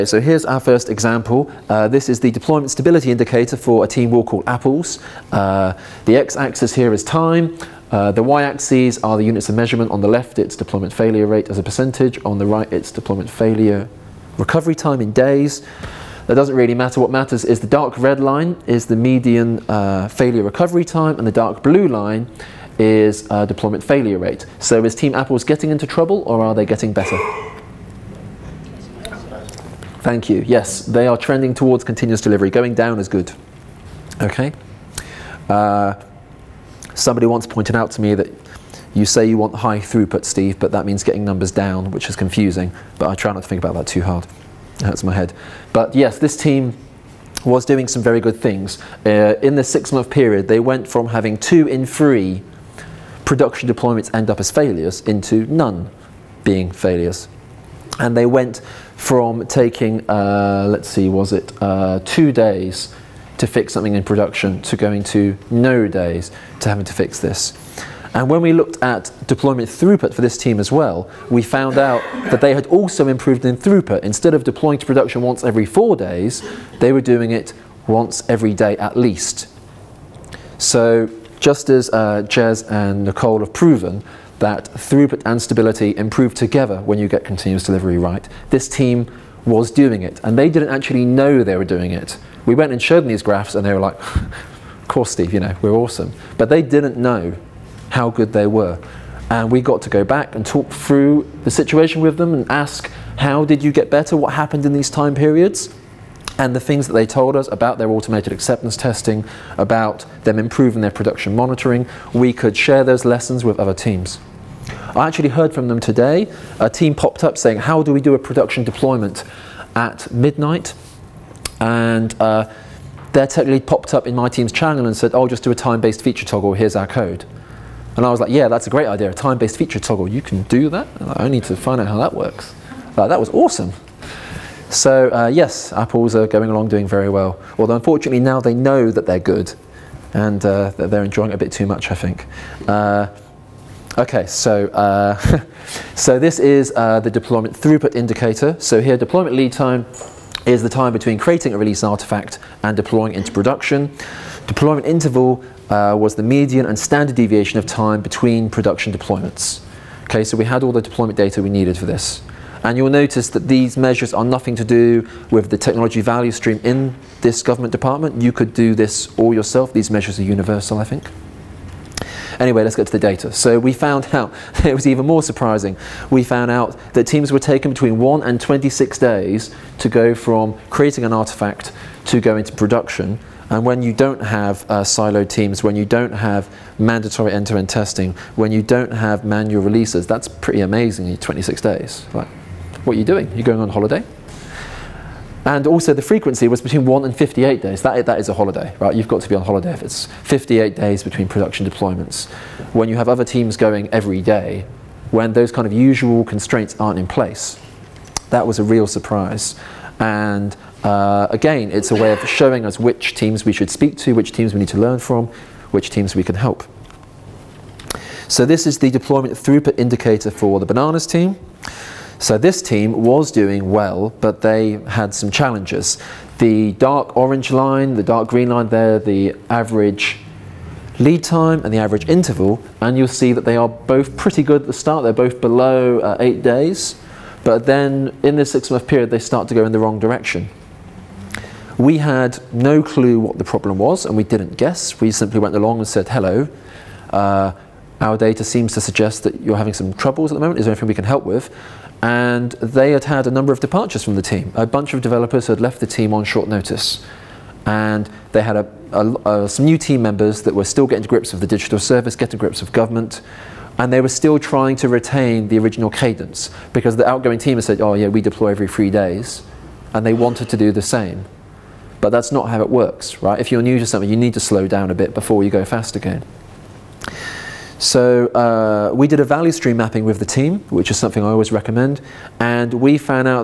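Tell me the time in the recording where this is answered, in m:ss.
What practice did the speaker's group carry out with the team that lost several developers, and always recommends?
4:39.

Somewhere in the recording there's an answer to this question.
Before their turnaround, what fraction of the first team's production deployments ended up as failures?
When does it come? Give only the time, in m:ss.
0:51.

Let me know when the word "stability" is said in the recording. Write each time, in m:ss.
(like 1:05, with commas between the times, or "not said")
0:02, 1:25.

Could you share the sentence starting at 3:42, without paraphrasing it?
So this team was doing well, but they had some challenges.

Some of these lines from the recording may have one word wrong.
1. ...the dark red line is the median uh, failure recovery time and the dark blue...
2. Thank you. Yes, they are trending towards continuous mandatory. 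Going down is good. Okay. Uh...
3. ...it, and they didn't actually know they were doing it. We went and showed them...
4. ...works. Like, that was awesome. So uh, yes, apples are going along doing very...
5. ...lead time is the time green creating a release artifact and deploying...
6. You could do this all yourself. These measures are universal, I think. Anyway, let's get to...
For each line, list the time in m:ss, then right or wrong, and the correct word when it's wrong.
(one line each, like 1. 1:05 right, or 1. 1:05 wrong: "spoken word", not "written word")
1. 0:17 right
2. 0:29 wrong: "delivery", not "mandatory"
3. 1:30 right
4. 2:12 right
5. 2:29 wrong: "between", not "green"
6. 2:48 right.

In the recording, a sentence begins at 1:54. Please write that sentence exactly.
I actually heard from them today.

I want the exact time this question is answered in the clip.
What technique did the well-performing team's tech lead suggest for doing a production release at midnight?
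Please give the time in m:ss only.
2:05.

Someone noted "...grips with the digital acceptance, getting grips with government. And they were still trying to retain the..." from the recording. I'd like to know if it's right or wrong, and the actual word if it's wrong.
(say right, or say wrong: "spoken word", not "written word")
wrong: "service", not "acceptance".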